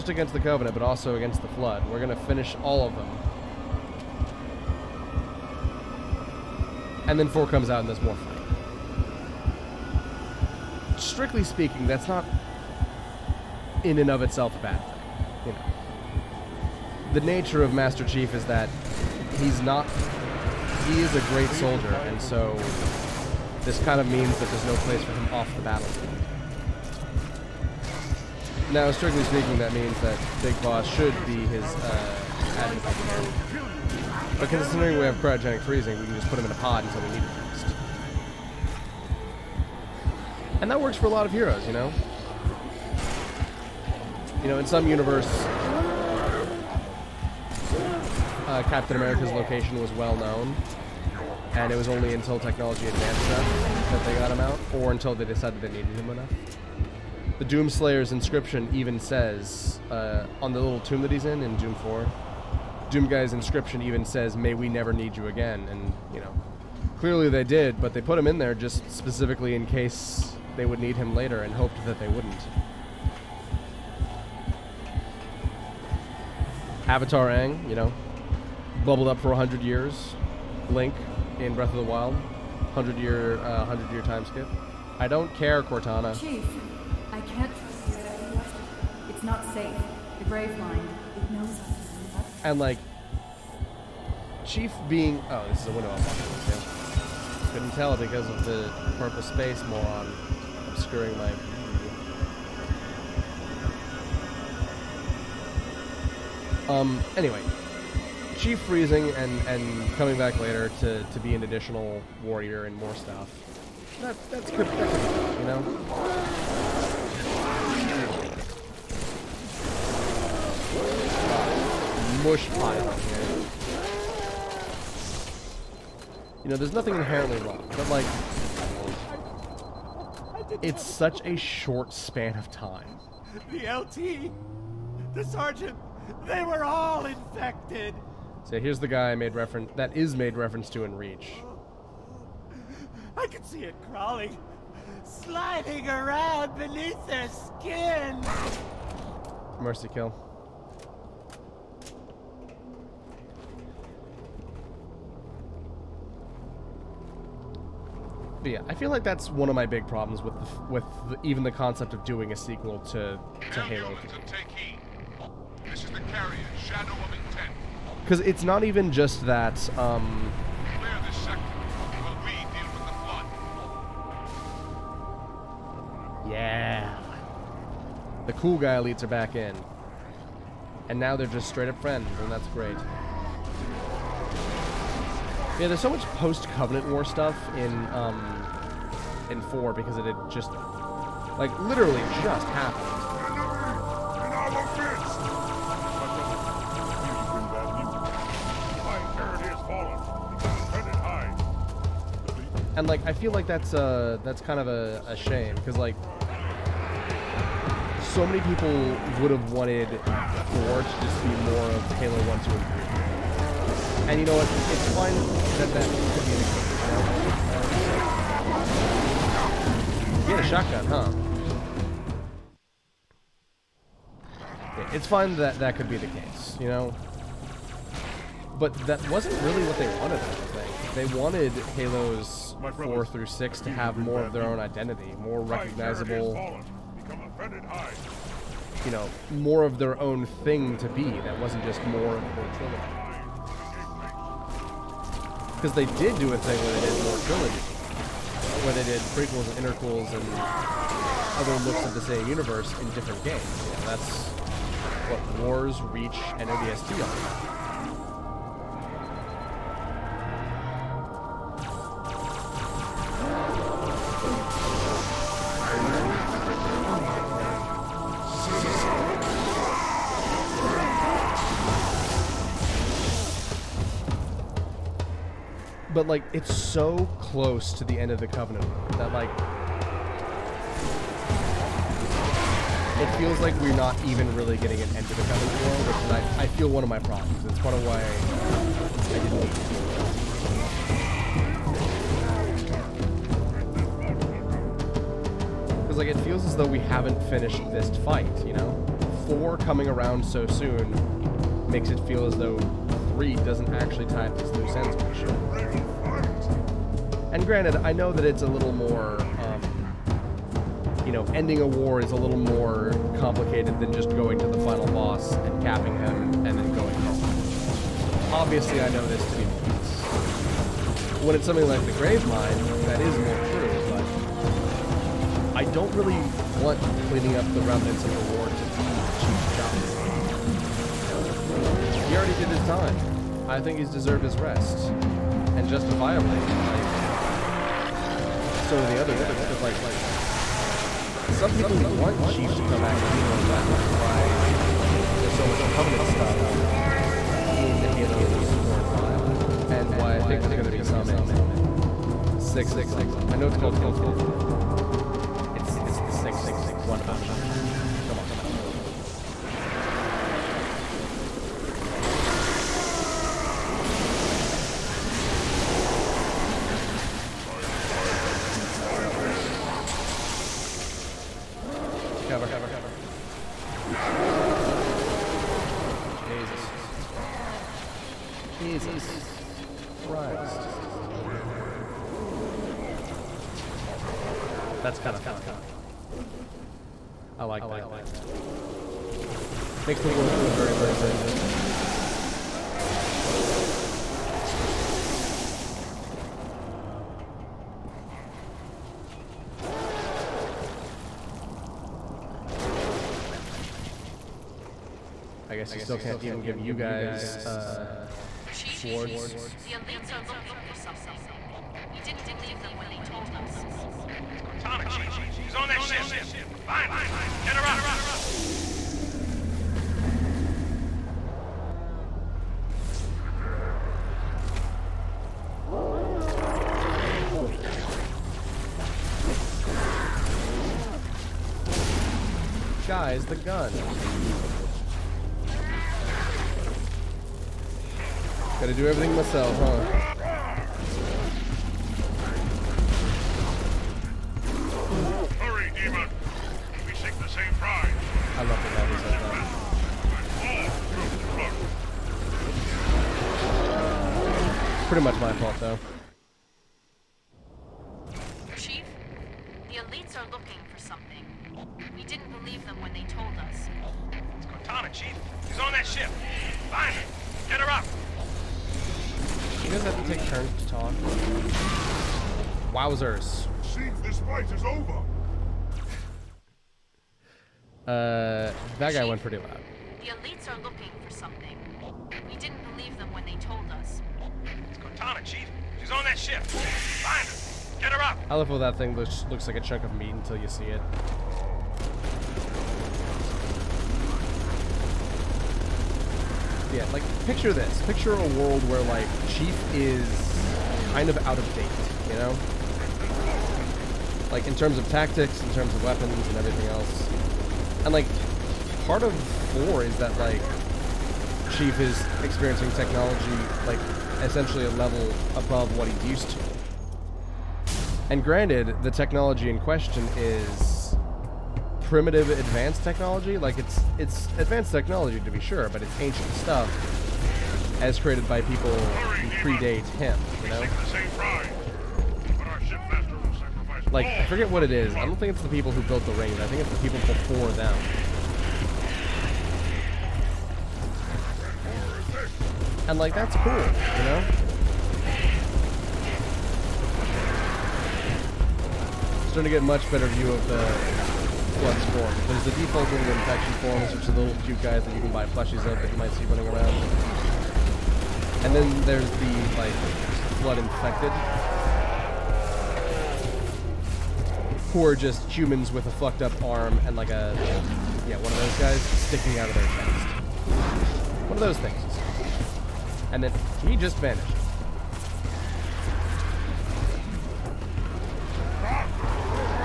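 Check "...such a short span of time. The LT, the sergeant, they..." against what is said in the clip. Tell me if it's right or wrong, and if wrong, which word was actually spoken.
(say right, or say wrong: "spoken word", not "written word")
right.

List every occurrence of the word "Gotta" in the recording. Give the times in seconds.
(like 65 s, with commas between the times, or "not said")
438 s.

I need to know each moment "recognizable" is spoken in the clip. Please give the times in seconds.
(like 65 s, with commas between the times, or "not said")
235 s.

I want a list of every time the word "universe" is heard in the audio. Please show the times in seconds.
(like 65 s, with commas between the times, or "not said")
44 s, 252 s.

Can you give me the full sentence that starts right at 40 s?
And that works for a lot of heroes, you know?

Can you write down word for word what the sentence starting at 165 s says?
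This is the carrier, Shadow of Intent.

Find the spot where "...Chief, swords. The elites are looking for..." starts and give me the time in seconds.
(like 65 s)
408 s.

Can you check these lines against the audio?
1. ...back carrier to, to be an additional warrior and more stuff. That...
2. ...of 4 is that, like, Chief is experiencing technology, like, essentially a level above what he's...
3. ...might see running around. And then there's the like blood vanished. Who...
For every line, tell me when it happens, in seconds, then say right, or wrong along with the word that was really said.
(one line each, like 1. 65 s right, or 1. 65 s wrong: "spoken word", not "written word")
1. 110 s wrong: "later", not "carrier"
2. 509 s right
3. 555 s wrong: "infected", not "vanished".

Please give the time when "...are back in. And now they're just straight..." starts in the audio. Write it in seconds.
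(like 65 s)
179 s.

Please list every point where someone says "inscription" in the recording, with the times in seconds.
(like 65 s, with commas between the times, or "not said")
58 s, 63 s.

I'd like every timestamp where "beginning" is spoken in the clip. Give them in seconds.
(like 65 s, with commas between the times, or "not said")
not said.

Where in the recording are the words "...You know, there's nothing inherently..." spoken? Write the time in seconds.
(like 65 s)
126 s.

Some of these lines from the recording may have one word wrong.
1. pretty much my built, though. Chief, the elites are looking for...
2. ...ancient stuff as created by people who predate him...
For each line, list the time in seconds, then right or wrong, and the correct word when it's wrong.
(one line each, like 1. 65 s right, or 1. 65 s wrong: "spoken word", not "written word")
1. 454 s wrong: "fault", not "built"
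2. 525 s right.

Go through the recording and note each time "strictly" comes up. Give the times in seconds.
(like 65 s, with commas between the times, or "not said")
10 s, 28 s.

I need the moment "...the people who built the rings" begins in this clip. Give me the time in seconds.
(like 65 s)
535 s.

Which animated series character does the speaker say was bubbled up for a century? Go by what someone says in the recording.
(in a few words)
Avatar Aang.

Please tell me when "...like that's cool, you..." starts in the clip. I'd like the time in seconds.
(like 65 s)
542 s.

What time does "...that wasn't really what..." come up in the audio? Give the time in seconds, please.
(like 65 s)
228 s.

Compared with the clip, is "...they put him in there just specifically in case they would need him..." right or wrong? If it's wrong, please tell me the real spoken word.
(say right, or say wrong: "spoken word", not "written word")
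right.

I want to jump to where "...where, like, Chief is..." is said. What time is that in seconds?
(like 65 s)
498 s.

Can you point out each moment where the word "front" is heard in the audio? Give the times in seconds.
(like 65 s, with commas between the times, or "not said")
not said.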